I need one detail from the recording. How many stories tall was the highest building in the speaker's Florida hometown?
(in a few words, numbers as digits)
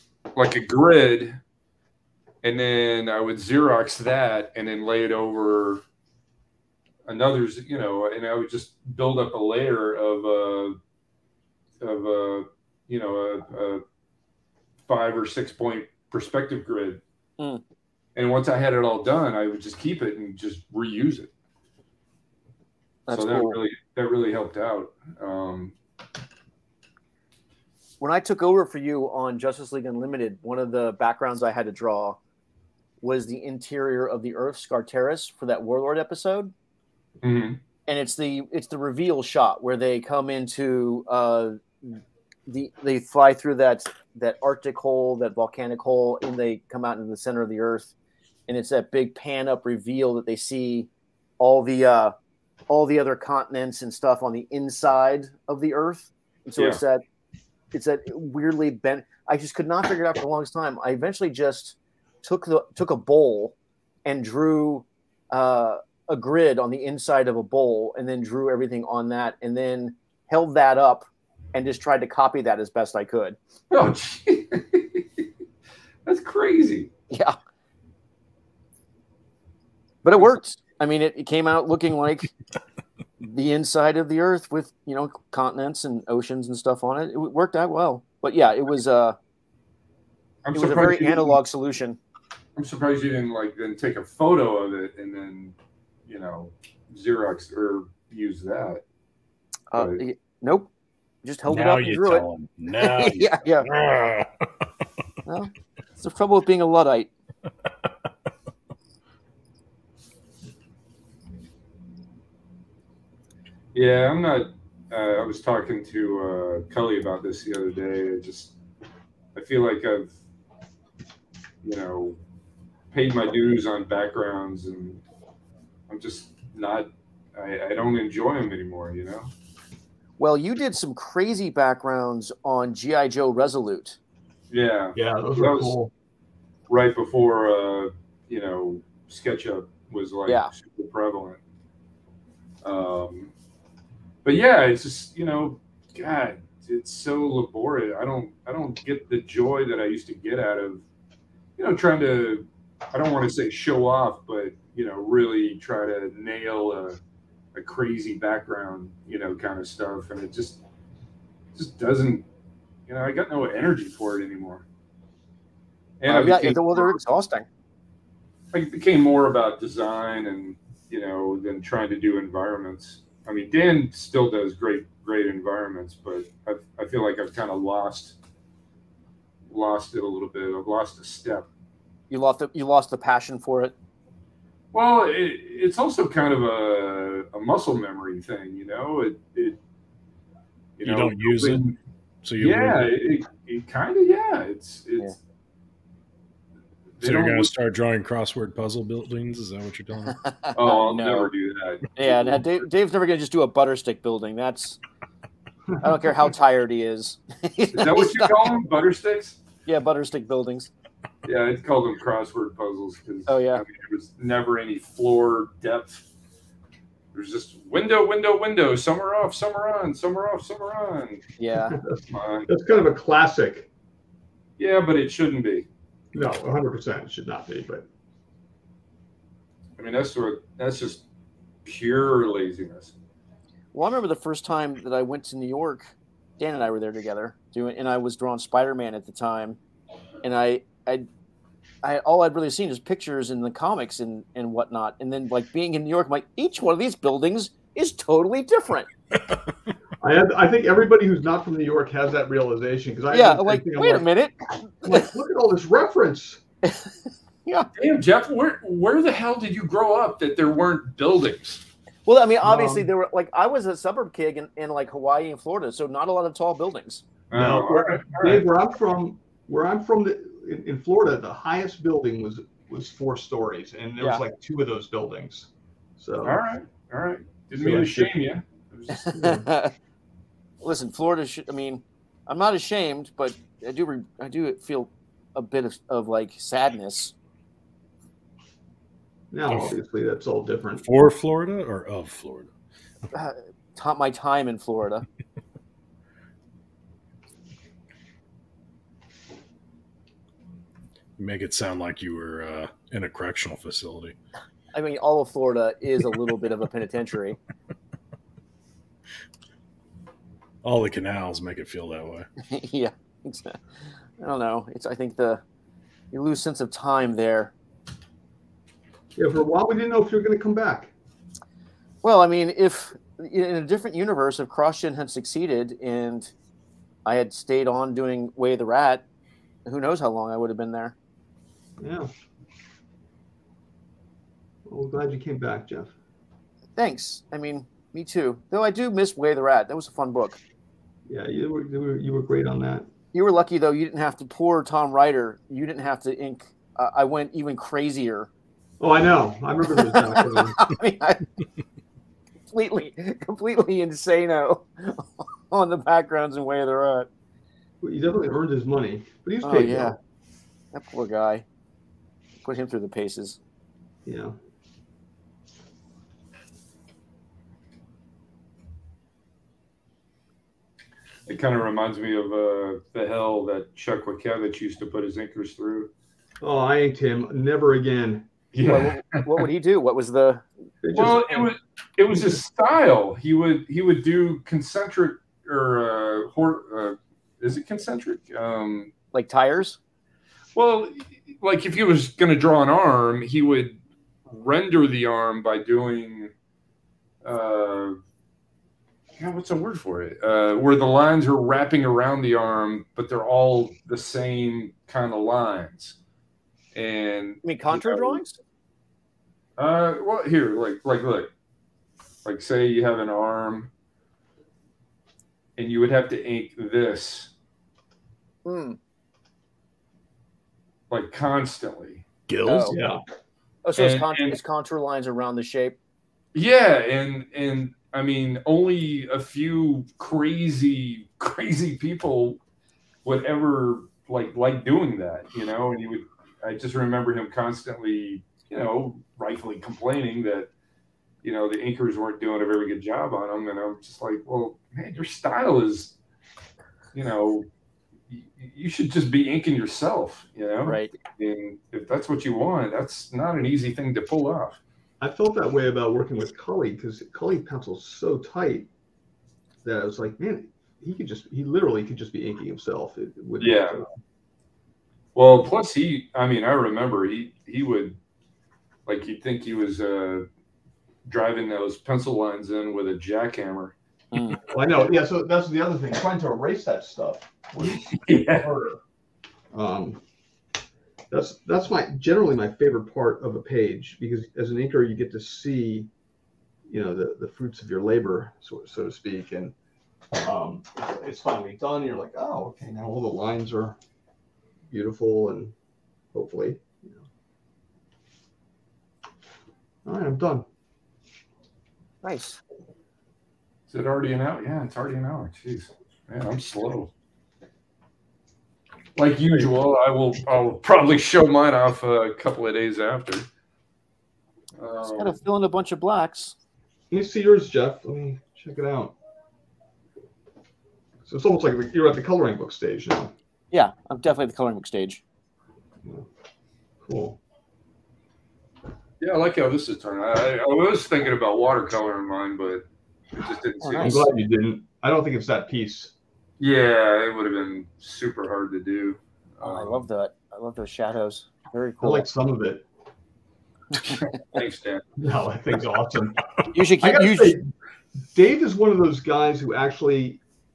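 4.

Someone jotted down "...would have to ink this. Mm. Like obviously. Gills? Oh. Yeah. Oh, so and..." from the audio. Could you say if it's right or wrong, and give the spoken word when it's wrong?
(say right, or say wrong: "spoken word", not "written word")
wrong: "constantly", not "obviously".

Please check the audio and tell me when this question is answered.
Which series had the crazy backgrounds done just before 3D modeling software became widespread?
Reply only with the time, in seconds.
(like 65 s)
132 s.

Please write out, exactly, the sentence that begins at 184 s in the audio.
Well, it, it's also kind of a, a muscle memory thing, you know.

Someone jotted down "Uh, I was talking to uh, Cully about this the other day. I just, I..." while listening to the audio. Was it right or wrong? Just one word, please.
right.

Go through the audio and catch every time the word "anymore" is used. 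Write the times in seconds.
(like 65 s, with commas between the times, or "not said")
128 s, 164 s.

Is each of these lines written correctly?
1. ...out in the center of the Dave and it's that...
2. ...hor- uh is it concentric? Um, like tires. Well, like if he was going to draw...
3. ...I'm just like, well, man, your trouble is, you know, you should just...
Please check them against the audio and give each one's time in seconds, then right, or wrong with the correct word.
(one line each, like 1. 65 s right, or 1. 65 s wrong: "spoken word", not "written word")
1. 46 s wrong: "Earth", not "Dave"
2. 386 s right
3. 443 s wrong: "style", not "trouble".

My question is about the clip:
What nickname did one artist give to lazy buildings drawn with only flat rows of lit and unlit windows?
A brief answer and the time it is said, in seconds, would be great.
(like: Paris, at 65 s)
Crossword puzzles, at 211 s.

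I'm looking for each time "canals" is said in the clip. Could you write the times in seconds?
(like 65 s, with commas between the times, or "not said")
310 s.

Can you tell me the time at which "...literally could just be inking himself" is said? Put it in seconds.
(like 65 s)
461 s.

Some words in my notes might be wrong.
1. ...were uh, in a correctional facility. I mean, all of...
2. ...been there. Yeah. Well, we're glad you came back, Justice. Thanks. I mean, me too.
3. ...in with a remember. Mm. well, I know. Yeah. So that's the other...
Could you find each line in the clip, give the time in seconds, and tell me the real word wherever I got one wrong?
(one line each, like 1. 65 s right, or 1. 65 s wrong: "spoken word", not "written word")
1. 302 s right
2. 330 s wrong: "Jeff", not "Justice"
3. 472 s wrong: "jackhammer", not "remember".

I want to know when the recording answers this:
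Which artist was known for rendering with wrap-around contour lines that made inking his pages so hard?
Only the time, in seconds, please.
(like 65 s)
373 s.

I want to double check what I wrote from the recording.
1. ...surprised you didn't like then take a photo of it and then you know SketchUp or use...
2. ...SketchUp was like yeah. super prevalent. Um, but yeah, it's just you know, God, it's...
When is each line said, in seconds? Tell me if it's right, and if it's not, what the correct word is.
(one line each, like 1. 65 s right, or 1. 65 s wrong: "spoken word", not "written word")
1. 92 s wrong: "Xerox", not "SketchUp"
2. 139 s right.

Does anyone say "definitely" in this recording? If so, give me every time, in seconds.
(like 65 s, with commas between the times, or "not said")
357 s, 523 s.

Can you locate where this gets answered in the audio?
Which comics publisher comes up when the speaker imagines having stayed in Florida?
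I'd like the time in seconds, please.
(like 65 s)
324 s.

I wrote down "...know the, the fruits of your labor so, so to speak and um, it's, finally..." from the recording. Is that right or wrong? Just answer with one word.
right.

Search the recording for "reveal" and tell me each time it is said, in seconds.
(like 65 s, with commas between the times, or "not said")
38 s, 49 s.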